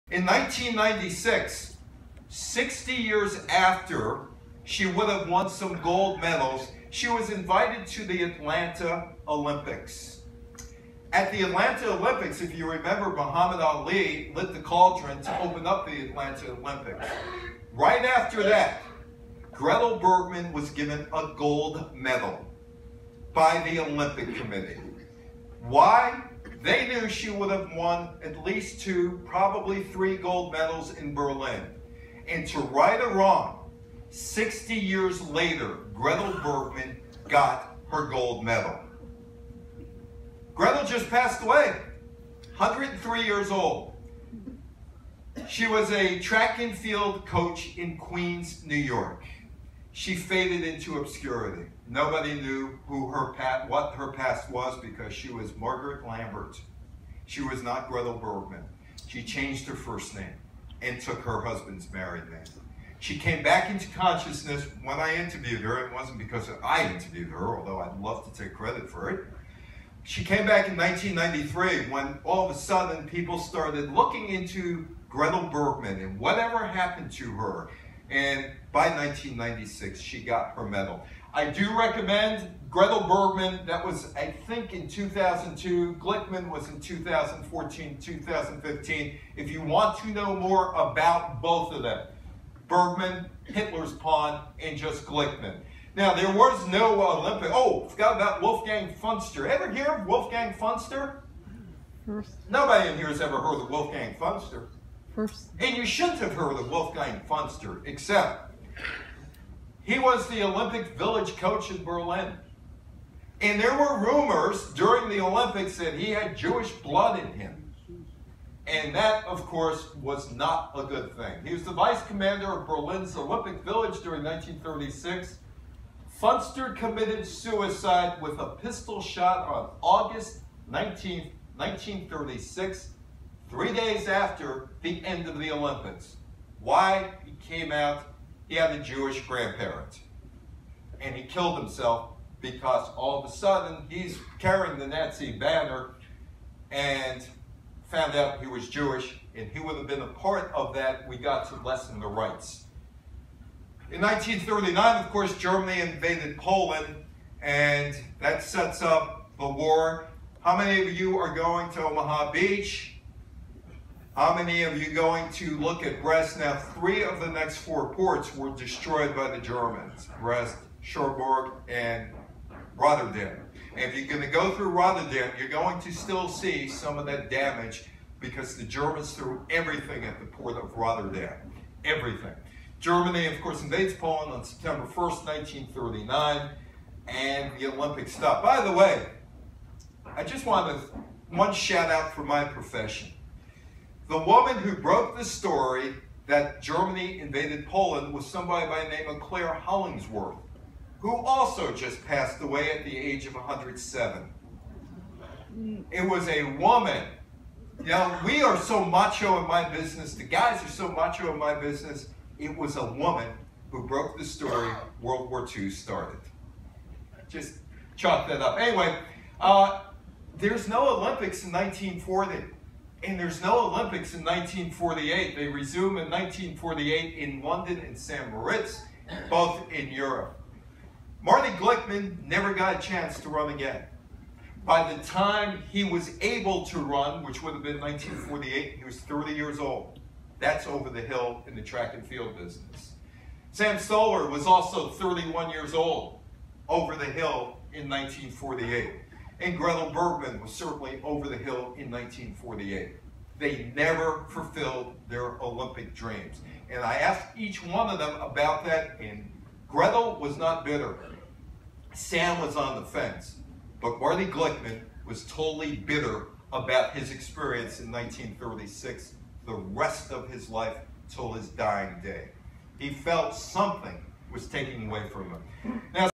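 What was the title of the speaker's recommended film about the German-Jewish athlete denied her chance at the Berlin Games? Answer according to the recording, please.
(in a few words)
Hitler's Pawn.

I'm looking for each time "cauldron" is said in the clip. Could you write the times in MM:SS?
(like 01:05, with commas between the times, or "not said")
00:14.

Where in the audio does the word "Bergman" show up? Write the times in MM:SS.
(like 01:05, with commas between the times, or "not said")
00:19, 00:36, 00:58, 01:15, 01:23, 01:32, 04:09.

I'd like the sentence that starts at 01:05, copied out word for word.
It wasn't because I interviewed her, although I'd love to take credit for it.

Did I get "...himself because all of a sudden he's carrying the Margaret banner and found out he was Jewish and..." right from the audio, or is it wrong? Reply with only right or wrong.
wrong.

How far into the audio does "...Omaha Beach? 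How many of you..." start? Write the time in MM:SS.
02:41.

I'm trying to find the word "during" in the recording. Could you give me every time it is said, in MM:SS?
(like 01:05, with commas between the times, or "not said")
01:54, 02:04.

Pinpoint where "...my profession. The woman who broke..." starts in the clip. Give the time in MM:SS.
03:12.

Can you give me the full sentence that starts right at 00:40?
Gretel just passed away, 103 years old.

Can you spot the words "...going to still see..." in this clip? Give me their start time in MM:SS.
02:55.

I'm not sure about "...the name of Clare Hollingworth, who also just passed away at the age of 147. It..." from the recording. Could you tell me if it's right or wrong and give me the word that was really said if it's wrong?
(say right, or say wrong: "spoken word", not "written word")
wrong: "107", not "147".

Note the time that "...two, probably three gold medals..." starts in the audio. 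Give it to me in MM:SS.
00:28.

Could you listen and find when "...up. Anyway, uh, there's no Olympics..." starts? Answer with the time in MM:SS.
03:38.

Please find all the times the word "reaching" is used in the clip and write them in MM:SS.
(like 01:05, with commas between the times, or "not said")
not said.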